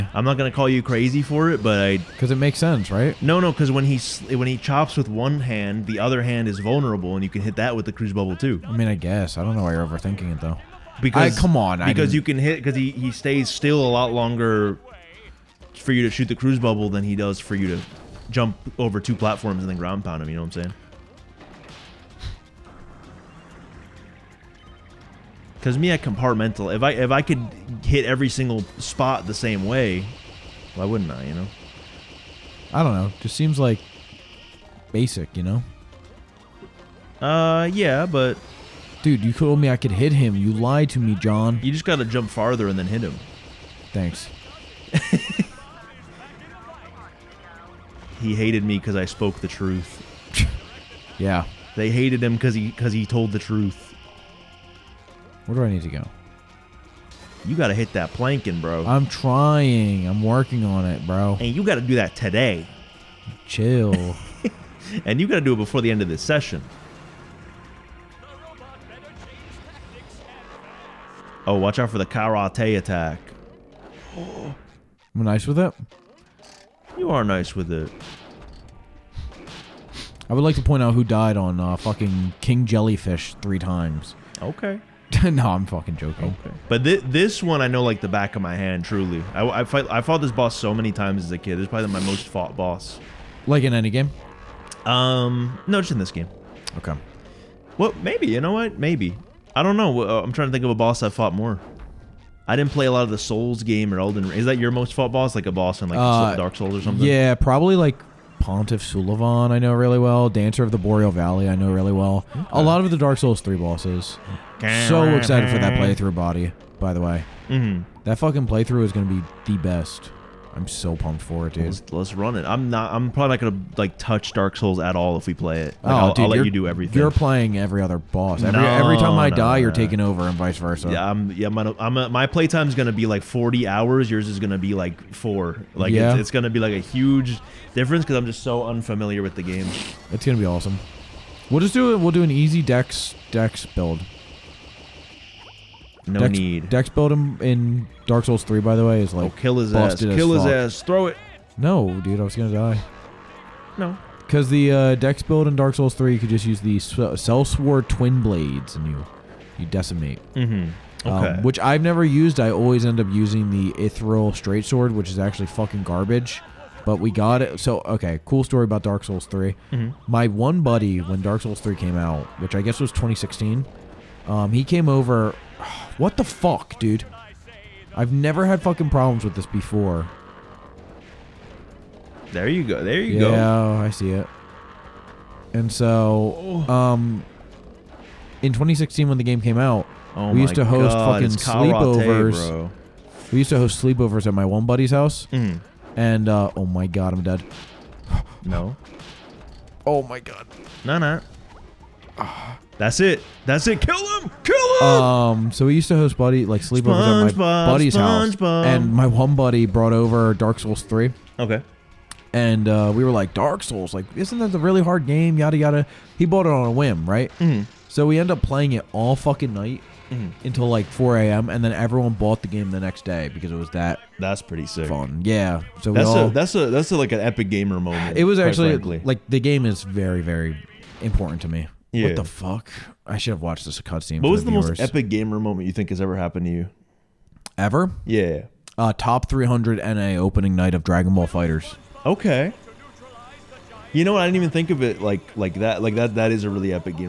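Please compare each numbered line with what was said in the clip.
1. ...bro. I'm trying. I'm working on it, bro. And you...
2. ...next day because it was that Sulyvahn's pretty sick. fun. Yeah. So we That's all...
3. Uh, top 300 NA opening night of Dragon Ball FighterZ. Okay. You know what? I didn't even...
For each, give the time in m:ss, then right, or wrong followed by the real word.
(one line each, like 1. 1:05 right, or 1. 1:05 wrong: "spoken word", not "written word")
1. 0:58 right
2. 3:42 wrong: "That", not "Sulyvahn"
3. 3:58 right.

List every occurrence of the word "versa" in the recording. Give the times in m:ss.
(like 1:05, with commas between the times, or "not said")
2:10.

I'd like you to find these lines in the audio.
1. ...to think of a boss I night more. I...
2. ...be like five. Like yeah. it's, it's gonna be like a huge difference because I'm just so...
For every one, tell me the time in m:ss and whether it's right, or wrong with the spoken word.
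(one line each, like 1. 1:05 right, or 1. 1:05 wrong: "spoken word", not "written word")
1. 1:40 wrong: "fought", not "night"
2. 2:14 wrong: "four", not "five".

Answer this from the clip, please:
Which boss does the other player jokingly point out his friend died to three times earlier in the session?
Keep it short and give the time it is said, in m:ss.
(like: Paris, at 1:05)
King Jellyfish, at 1:22.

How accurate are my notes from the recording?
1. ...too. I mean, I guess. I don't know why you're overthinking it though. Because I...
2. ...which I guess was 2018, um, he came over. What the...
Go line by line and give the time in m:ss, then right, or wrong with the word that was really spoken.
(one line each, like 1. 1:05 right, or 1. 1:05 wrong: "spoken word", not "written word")
1. 0:08 right
2. 2:52 wrong: "2016", not "2018".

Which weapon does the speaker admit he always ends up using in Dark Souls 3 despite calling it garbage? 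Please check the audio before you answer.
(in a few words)
Irithyll Straight Sword.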